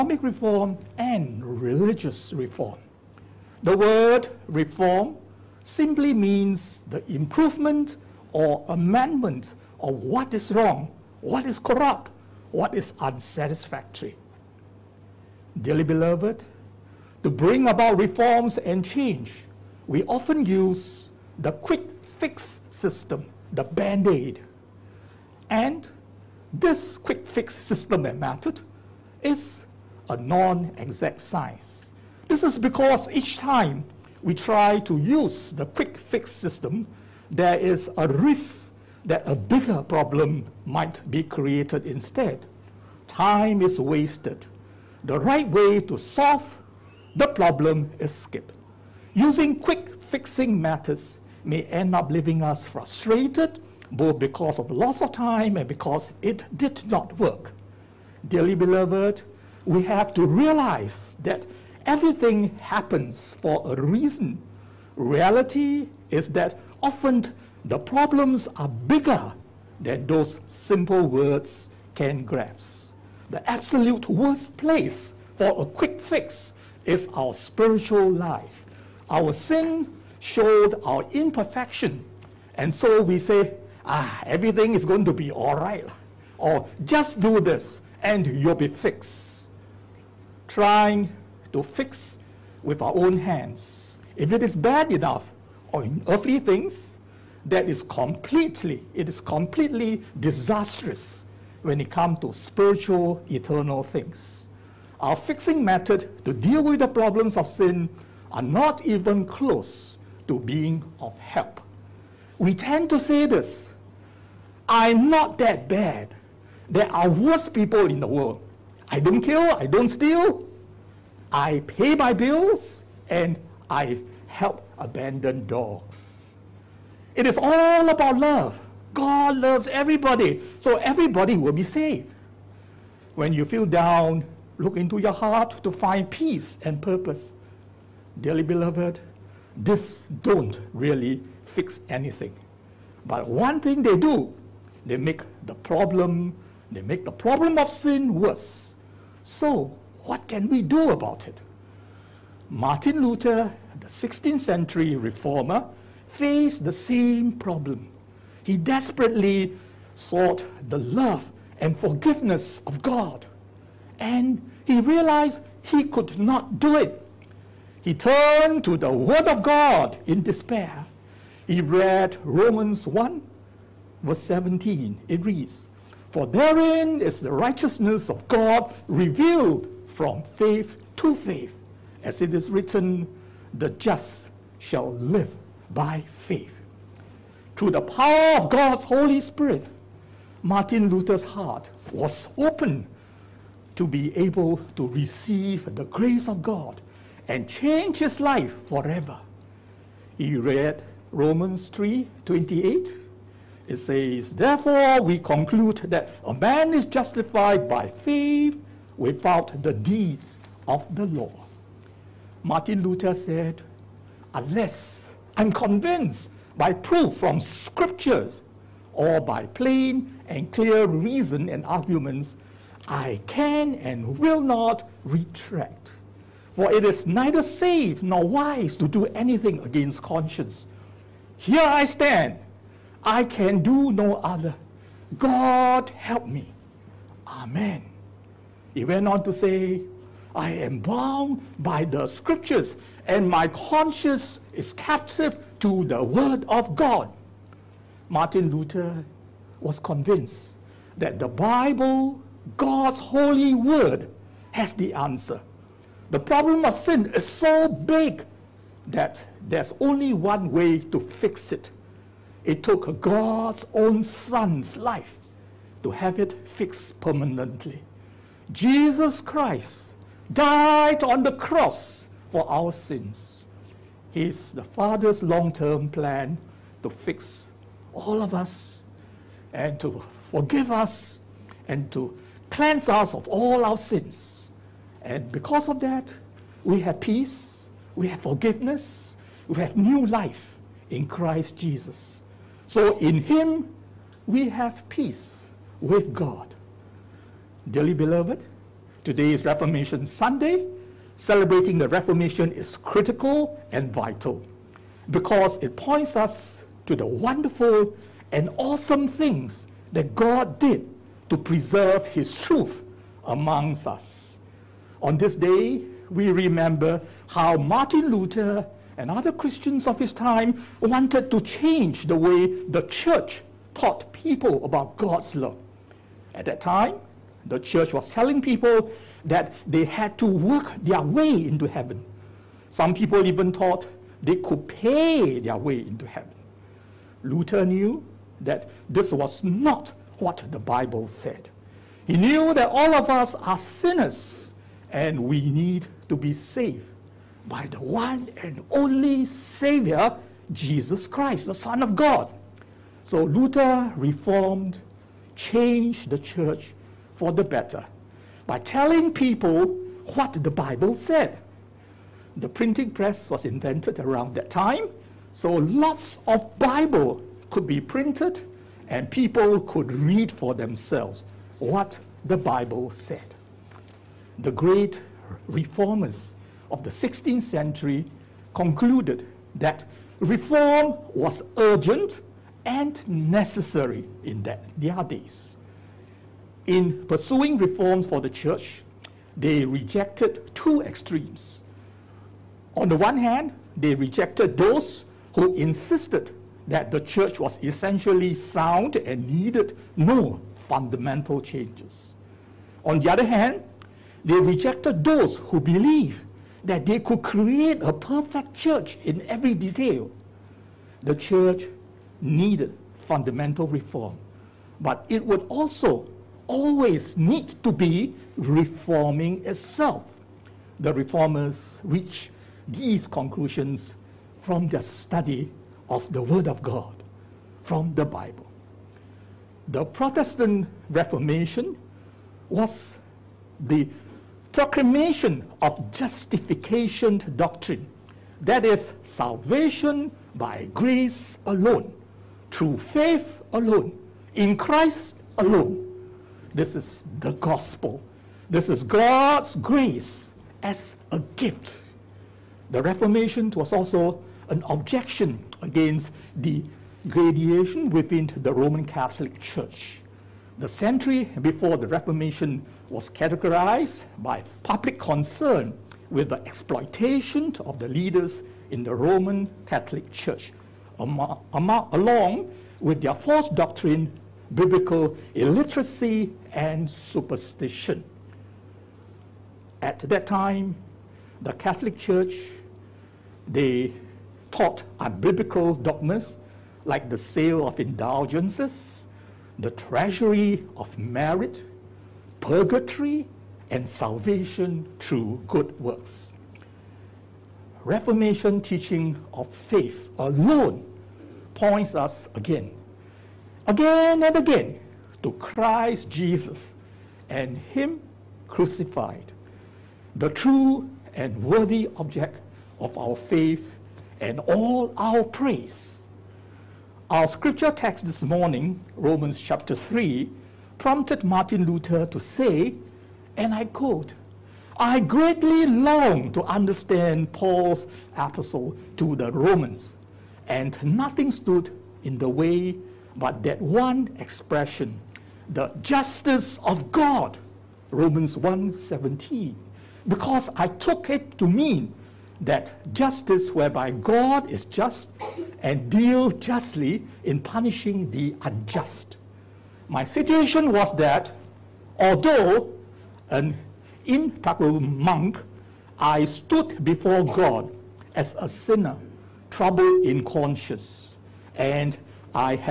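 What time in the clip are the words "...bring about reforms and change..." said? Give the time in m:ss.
0:17.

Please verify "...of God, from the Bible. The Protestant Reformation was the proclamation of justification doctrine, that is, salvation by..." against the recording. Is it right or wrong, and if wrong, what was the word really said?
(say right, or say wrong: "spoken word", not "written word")
right.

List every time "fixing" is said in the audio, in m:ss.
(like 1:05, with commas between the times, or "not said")
0:50, 1:45.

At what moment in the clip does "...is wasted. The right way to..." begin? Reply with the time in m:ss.
0:43.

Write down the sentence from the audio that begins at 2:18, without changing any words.
Dearly beloved, this don't really fix anything.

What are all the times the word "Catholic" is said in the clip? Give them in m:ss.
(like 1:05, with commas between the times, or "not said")
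7:38, 7:49, 8:01.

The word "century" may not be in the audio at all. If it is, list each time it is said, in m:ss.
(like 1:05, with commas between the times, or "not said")
2:34, 6:17, 7:40.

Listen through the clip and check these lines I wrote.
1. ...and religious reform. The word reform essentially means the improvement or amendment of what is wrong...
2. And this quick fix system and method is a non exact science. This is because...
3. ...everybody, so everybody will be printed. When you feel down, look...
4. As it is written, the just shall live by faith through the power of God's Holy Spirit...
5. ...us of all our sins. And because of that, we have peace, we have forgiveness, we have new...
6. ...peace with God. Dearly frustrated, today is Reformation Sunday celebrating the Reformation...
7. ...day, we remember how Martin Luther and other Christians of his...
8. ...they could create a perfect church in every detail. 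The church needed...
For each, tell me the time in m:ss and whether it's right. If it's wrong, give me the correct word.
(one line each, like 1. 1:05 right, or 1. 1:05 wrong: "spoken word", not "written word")
1. 0:00 wrong: "simply", not "essentially"
2. 0:25 right
3. 2:09 wrong: "saved", not "printed"
4. 3:02 right
5. 4:42 right
6. 4:54 wrong: "beloved", not "frustrated"
7. 5:15 right
8. 6:46 right.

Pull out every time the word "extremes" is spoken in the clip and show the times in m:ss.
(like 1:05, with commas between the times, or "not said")
6:30.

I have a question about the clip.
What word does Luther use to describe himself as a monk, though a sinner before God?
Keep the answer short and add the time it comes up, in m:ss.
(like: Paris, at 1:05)
Impeccable, at 9:14.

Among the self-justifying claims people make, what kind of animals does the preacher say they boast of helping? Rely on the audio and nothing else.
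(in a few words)
Abandoned dogs.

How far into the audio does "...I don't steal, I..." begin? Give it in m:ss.
1:59.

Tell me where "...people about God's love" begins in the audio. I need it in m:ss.
5:24.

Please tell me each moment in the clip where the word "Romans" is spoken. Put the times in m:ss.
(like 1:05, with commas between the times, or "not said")
2:52, 3:21, 7:38, 7:48, 8:38, 8:49, 8:57.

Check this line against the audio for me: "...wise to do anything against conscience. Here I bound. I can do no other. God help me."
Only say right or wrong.
wrong.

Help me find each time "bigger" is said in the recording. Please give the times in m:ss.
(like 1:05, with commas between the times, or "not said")
0:39, 1:08.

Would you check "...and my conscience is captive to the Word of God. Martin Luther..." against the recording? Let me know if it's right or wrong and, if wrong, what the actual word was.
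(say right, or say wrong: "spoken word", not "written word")
right.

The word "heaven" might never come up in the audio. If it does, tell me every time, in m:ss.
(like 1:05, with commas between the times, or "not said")
5:31, 5:36.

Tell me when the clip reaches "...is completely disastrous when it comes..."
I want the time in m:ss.
1:39.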